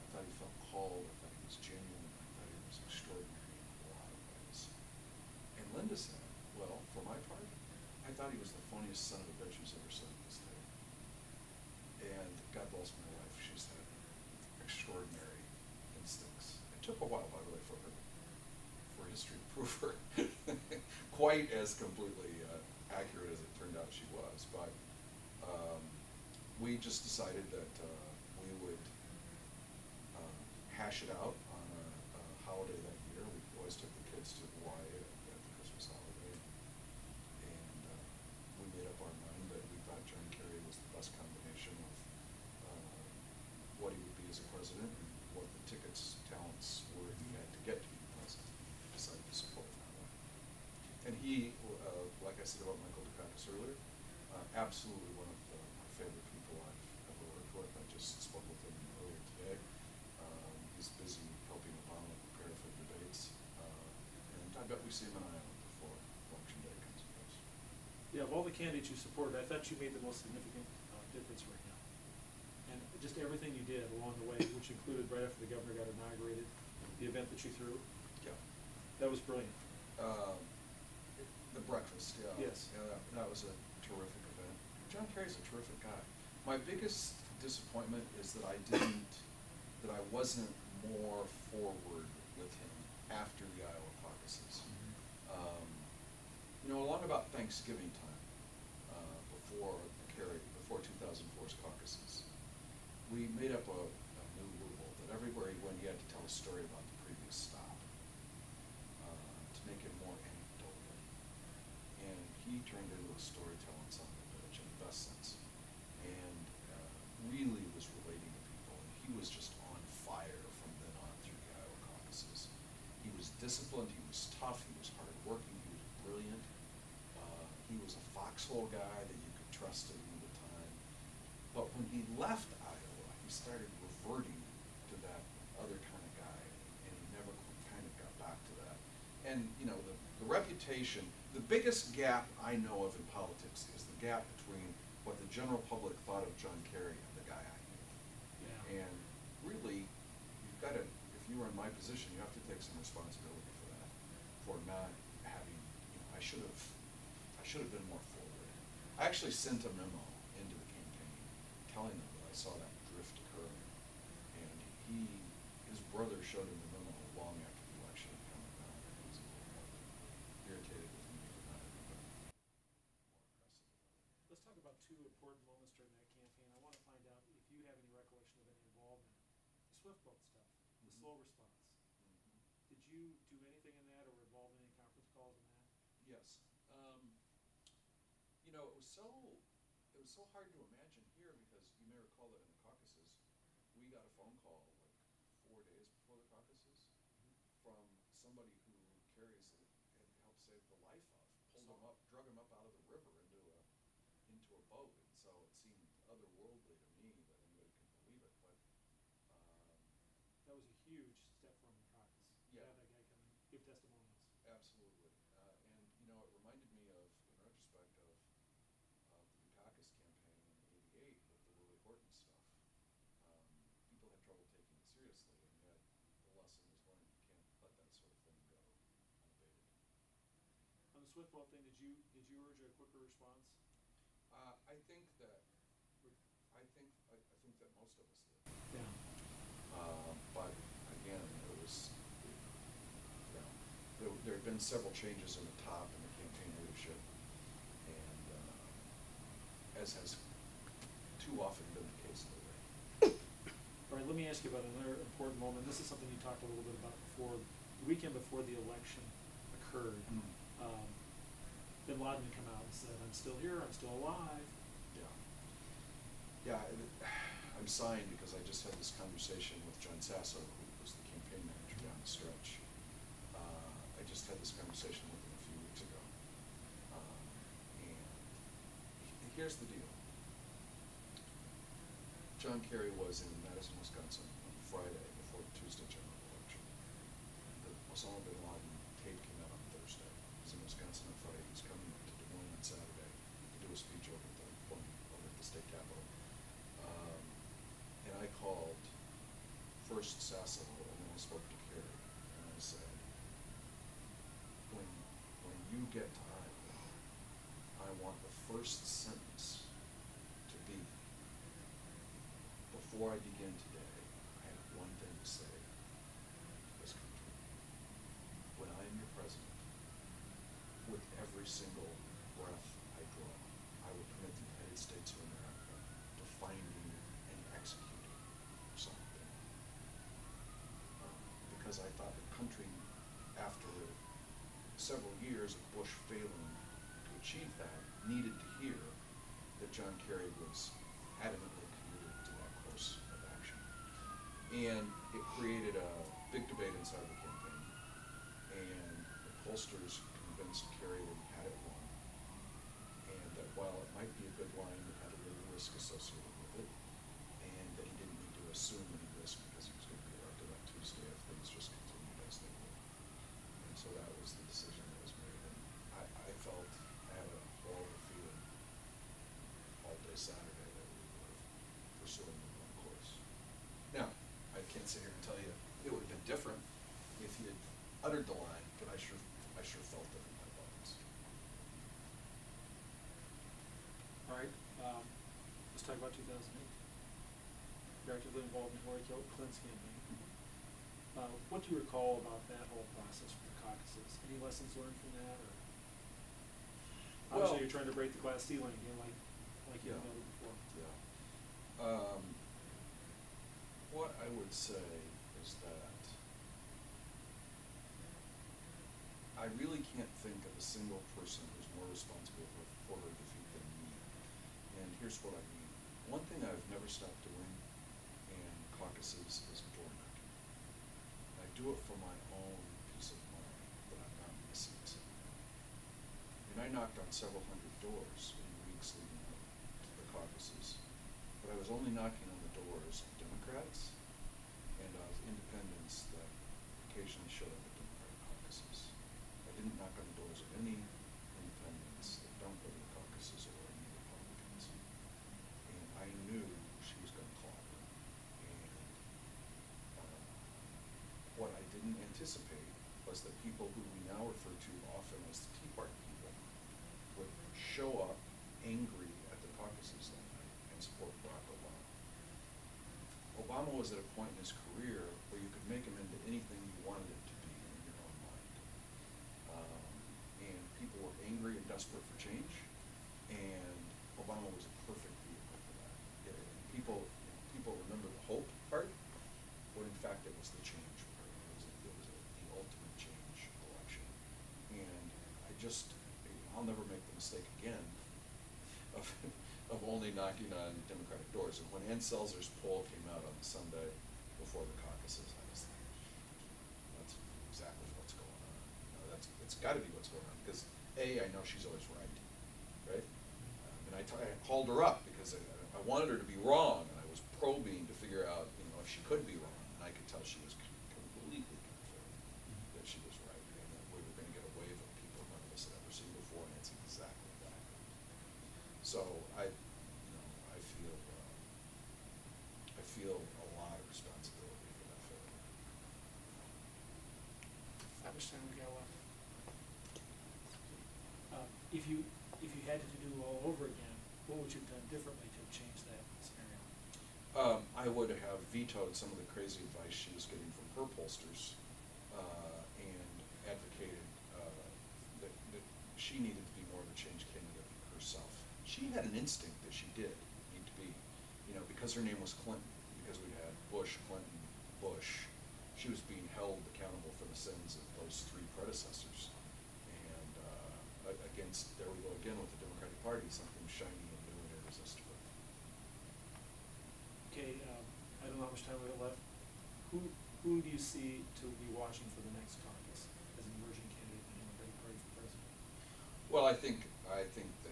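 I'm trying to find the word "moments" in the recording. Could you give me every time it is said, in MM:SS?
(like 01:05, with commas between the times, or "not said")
02:55, 04:15.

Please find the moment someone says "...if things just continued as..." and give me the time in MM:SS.
06:01.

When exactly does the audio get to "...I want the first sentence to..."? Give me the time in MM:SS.
05:07.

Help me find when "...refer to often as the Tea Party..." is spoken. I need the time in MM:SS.
07:34.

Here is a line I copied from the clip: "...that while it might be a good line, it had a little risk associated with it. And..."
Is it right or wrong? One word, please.
right.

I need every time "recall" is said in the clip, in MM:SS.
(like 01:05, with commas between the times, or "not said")
03:11, 06:31.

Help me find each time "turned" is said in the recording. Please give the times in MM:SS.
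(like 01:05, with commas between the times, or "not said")
00:23, 01:52.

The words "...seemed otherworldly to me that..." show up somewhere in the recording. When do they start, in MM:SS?
03:25.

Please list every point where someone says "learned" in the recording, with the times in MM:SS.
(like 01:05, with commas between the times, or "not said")
03:46, 06:34.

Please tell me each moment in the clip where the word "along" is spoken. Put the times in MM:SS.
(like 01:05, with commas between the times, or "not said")
01:13, 01:36.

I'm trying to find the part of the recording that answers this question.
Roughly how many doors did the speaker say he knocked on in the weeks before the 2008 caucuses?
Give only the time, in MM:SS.
07:07.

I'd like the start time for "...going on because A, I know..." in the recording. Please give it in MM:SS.
08:20.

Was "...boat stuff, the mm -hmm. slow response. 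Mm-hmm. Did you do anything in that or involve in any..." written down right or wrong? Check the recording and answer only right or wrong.
right.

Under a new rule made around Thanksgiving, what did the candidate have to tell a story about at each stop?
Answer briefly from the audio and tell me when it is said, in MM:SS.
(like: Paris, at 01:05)
The previous stop, at 01:46.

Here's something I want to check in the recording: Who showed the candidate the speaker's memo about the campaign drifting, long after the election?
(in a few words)
His brother.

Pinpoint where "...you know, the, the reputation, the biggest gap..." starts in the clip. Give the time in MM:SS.
02:19.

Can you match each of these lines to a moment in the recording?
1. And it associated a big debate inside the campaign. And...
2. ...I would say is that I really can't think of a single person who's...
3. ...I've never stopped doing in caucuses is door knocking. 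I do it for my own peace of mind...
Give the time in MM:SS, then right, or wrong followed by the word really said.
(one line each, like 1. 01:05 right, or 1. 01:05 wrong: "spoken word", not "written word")
1. 05:44 wrong: "created", not "associated"
2. 06:44 right
3. 06:56 right.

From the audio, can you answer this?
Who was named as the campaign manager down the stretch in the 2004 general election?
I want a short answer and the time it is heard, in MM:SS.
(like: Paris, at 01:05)
John Sasso, at 04:29.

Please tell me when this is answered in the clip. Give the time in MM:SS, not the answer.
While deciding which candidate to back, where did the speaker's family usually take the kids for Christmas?
00:34.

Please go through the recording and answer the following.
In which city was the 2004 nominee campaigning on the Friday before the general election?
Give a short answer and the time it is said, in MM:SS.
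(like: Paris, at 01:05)
Madison, Wisconsin, at 04:43.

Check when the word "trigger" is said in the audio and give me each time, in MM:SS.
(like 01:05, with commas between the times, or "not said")
not said.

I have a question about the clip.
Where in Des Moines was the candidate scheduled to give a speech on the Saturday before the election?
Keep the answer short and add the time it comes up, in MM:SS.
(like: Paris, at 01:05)
State capitol, at 04:55.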